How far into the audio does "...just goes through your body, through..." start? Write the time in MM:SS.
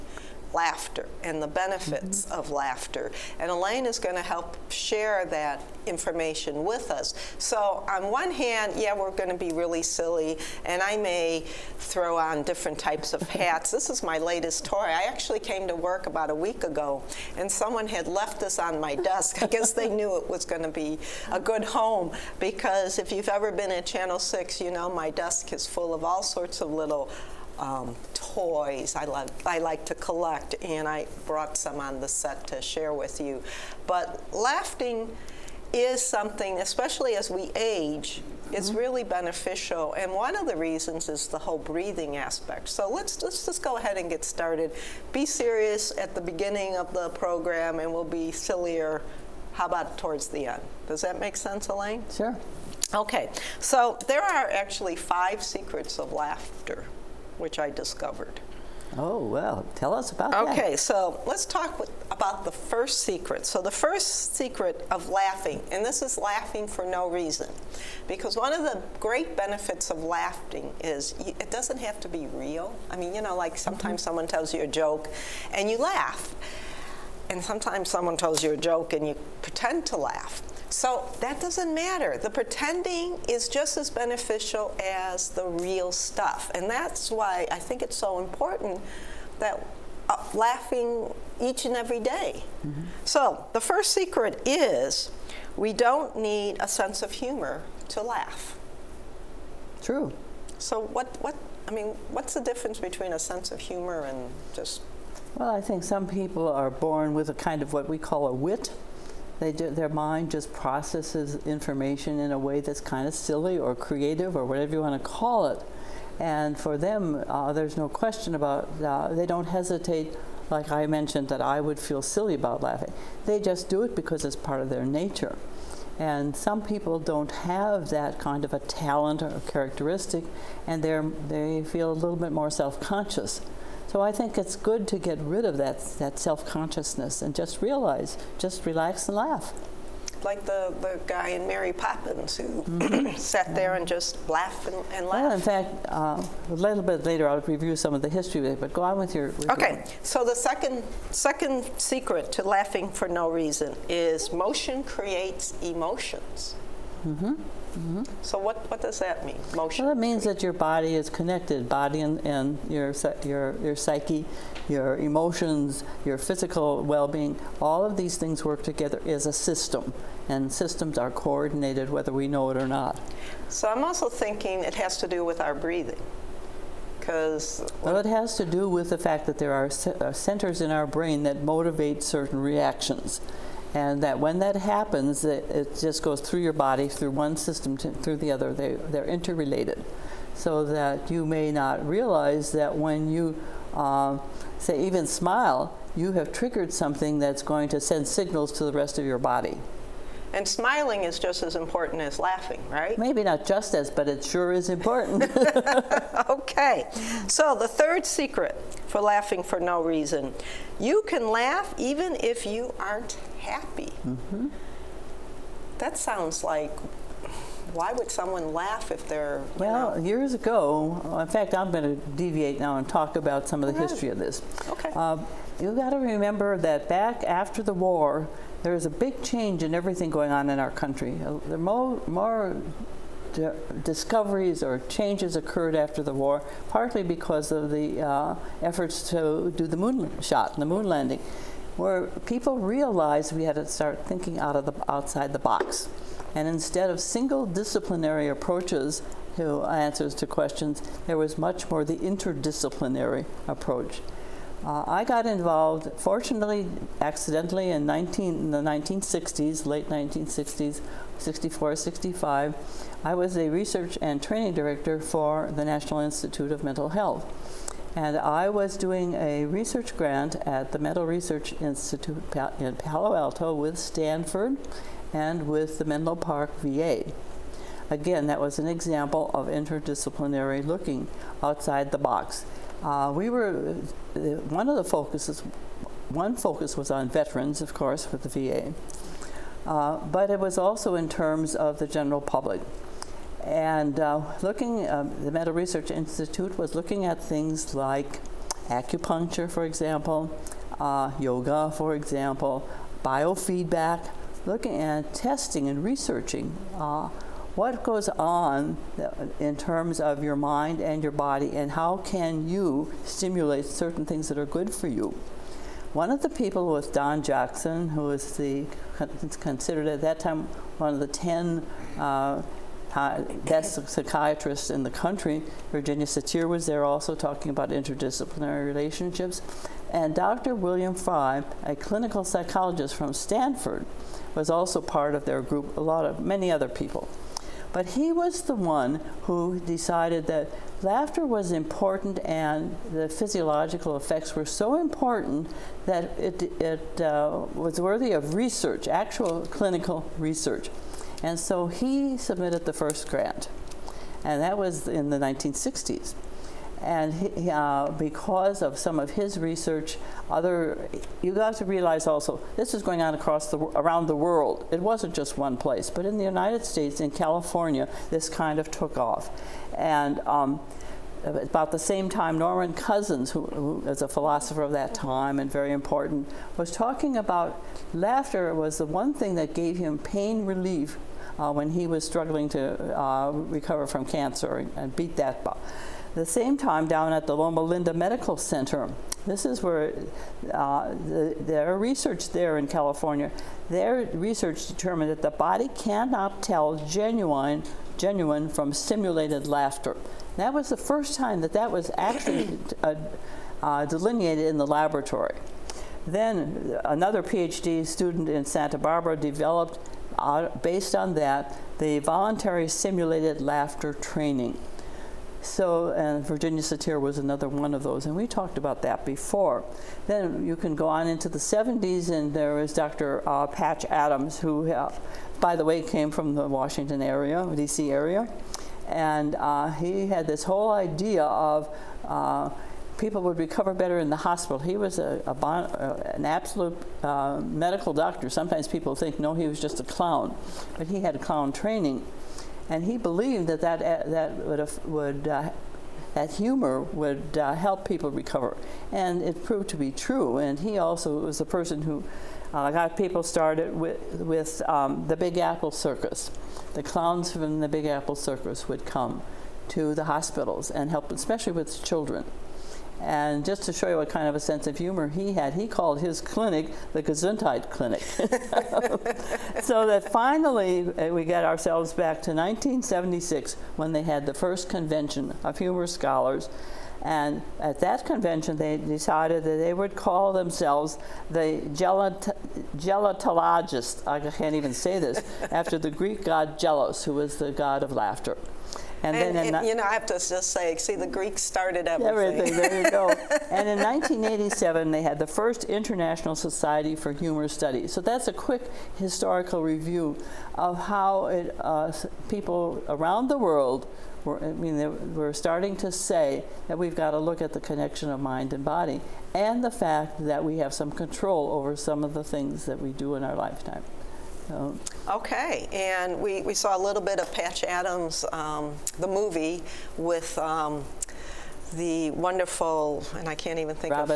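03:05.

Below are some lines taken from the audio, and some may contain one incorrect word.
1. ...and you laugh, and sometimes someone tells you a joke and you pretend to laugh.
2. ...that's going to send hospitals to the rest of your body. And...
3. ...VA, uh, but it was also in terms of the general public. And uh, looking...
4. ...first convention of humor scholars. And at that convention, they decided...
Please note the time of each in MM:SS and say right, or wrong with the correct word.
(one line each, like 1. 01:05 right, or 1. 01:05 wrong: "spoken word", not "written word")
1. 01:15 right
2. 03:17 wrong: "signals", not "hospitals"
3. 04:48 right
4. 07:54 right.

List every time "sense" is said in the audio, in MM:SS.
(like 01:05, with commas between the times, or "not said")
00:51, 01:36, 01:43, 07:44.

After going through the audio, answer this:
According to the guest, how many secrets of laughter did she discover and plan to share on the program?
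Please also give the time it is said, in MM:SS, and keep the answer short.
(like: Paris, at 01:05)
5, at 00:54.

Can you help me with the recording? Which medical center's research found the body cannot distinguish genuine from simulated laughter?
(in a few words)
Loma Linda Medical Center.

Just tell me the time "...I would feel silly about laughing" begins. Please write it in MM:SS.
02:01.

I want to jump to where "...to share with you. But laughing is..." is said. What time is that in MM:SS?
00:32.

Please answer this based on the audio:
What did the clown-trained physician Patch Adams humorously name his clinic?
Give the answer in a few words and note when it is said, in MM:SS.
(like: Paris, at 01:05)
Gesundheit Clinic, at 07:47.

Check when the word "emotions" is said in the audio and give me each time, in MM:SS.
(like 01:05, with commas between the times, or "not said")
02:35, 02:44.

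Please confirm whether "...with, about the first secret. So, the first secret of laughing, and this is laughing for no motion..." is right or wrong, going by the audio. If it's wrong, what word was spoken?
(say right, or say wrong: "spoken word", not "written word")
wrong: "reason", not "motion".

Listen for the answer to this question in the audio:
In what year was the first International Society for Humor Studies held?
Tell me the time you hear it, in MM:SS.
08:13.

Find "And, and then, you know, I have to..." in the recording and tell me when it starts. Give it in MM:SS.
08:09.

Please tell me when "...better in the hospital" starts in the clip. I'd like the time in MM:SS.
07:13.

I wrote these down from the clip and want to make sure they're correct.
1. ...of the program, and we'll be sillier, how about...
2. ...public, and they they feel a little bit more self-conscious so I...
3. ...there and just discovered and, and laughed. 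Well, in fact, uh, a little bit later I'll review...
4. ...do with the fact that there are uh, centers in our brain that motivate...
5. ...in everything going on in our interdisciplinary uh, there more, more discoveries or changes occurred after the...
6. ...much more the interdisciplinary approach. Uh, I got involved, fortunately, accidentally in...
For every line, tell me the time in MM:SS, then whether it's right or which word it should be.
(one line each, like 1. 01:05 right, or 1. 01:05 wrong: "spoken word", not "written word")
1. 00:46 right
2. 02:09 wrong: "characteristic", not "public"
3. 02:23 wrong: "laughed", not "discovered"
4. 02:58 right
5. 03:49 wrong: "country", not "interdisciplinary"
6. 04:11 right.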